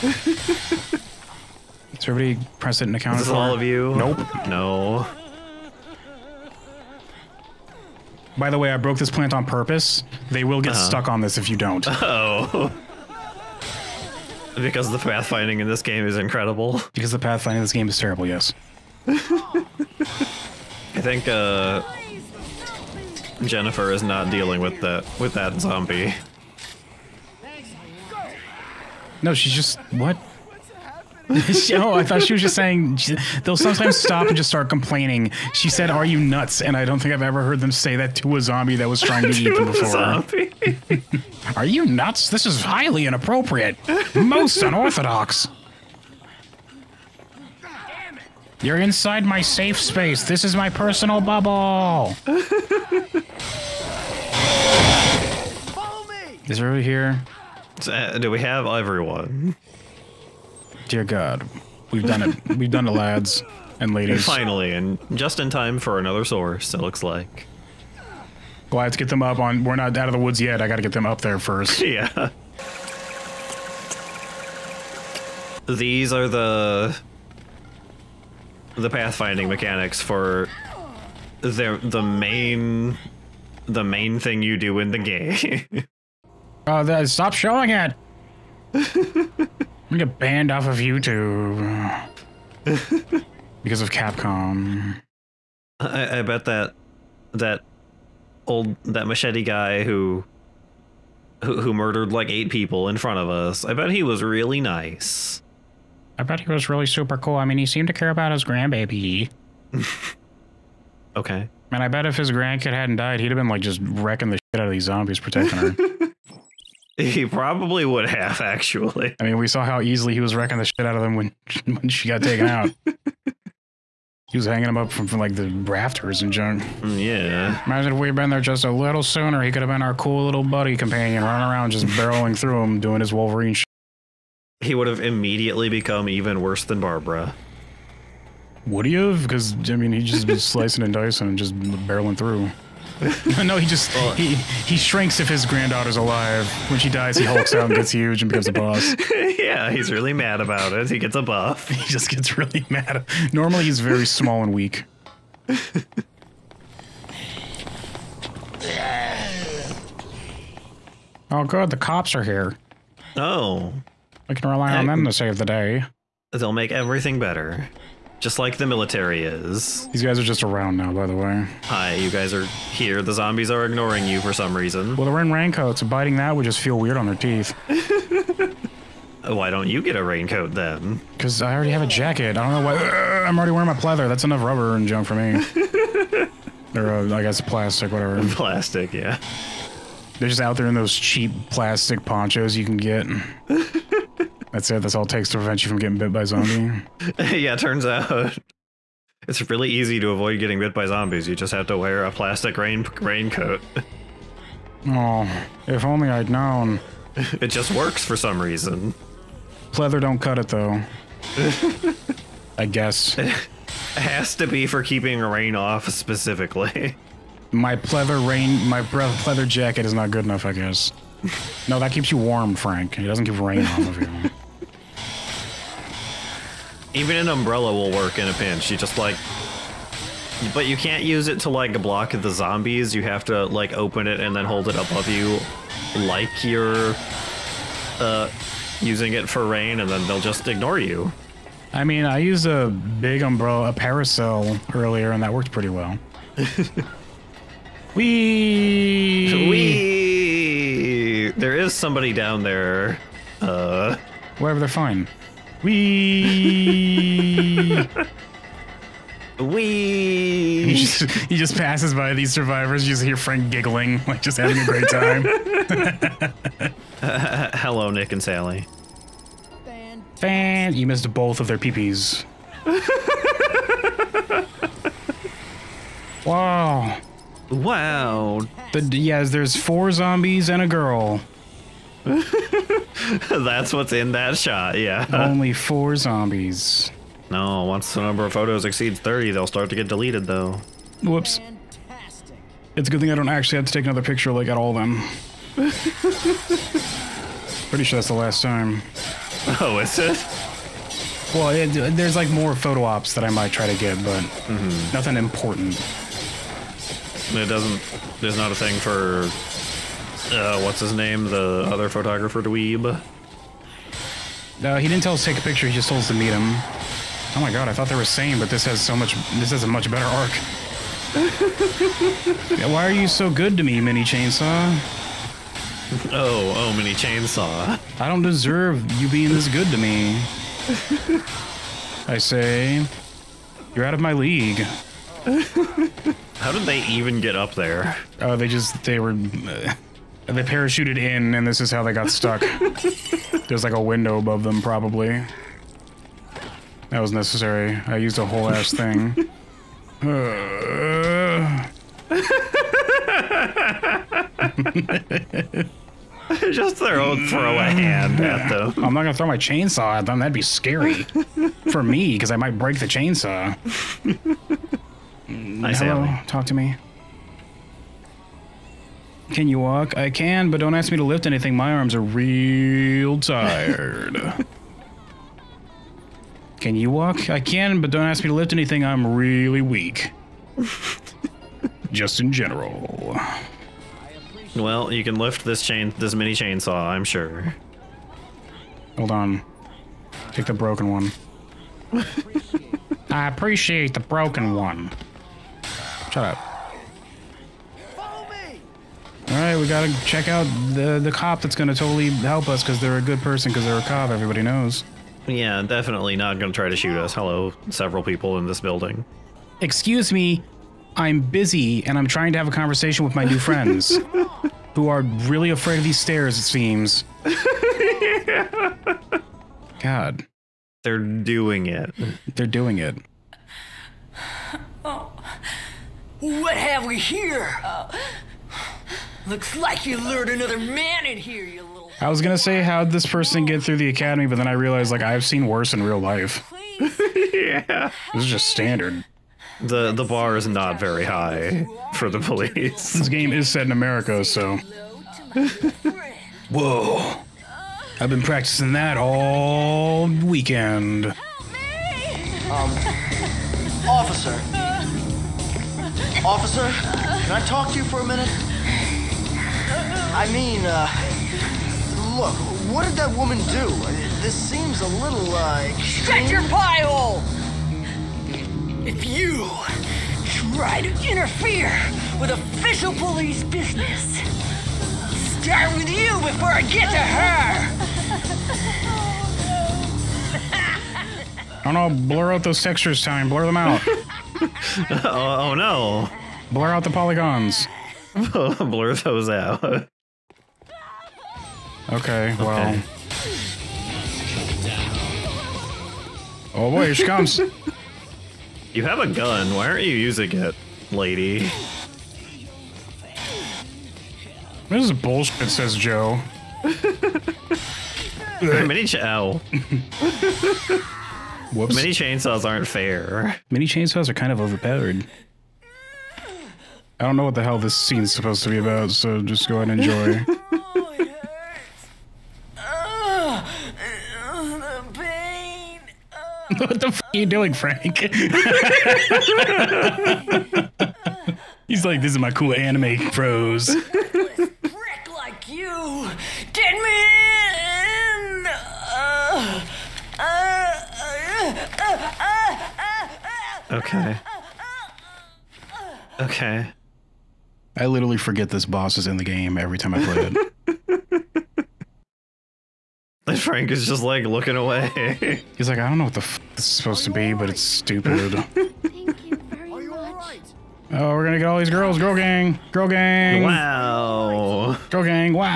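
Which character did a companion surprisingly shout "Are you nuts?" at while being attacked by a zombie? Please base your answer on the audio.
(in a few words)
Jennifer.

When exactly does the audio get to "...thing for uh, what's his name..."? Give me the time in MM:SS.
05:08.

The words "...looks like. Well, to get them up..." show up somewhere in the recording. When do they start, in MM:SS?
01:06.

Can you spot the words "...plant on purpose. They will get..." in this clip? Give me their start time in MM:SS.
00:09.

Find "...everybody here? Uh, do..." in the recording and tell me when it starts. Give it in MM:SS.
00:56.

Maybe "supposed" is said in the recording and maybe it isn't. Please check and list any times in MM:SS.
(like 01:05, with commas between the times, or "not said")
08:38, 09:16.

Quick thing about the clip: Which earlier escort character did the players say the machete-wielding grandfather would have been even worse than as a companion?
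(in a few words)
Barbara.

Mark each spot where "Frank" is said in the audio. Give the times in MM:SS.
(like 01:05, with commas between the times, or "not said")
03:42, 04:23, 08:47, 09:13.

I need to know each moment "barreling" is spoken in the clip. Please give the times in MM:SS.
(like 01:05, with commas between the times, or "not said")
02:11, 02:21.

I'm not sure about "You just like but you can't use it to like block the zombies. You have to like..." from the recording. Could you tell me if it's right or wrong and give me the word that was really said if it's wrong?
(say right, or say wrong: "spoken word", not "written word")
right.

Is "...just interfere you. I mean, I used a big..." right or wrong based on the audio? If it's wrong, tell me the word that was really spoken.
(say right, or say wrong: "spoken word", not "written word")
wrong: "ignore", not "interfere".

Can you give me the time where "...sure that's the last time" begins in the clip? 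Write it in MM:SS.
04:57.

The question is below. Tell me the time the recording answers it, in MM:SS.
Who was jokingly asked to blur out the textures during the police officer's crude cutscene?
08:03.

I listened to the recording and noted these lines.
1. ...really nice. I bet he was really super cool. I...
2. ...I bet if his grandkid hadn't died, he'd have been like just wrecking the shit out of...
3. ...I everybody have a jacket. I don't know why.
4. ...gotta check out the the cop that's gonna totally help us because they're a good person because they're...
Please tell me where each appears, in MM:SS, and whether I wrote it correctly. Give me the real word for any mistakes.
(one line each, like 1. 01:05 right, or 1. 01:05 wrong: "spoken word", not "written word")
1. 01:44 right
2. 01:51 right
3. 03:01 wrong: "already", not "everybody"
4. 06:39 right.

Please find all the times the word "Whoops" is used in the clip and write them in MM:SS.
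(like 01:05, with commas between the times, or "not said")
04:51, 08:31.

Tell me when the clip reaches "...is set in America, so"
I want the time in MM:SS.
07:23.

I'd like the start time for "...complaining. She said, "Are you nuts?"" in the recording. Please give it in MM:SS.
00:34.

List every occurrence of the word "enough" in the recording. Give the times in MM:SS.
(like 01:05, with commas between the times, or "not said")
03:04, 03:40.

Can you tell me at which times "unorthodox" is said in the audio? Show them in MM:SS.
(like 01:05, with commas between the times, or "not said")
00:44.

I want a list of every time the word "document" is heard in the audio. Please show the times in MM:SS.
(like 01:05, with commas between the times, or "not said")
not said.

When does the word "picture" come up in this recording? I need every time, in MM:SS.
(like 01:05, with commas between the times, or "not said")
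04:54, 05:15.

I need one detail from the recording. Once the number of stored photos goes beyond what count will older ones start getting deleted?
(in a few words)
30.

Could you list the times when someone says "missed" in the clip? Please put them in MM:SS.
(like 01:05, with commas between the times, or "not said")
04:30.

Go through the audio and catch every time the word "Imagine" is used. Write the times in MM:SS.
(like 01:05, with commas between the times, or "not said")
02:07.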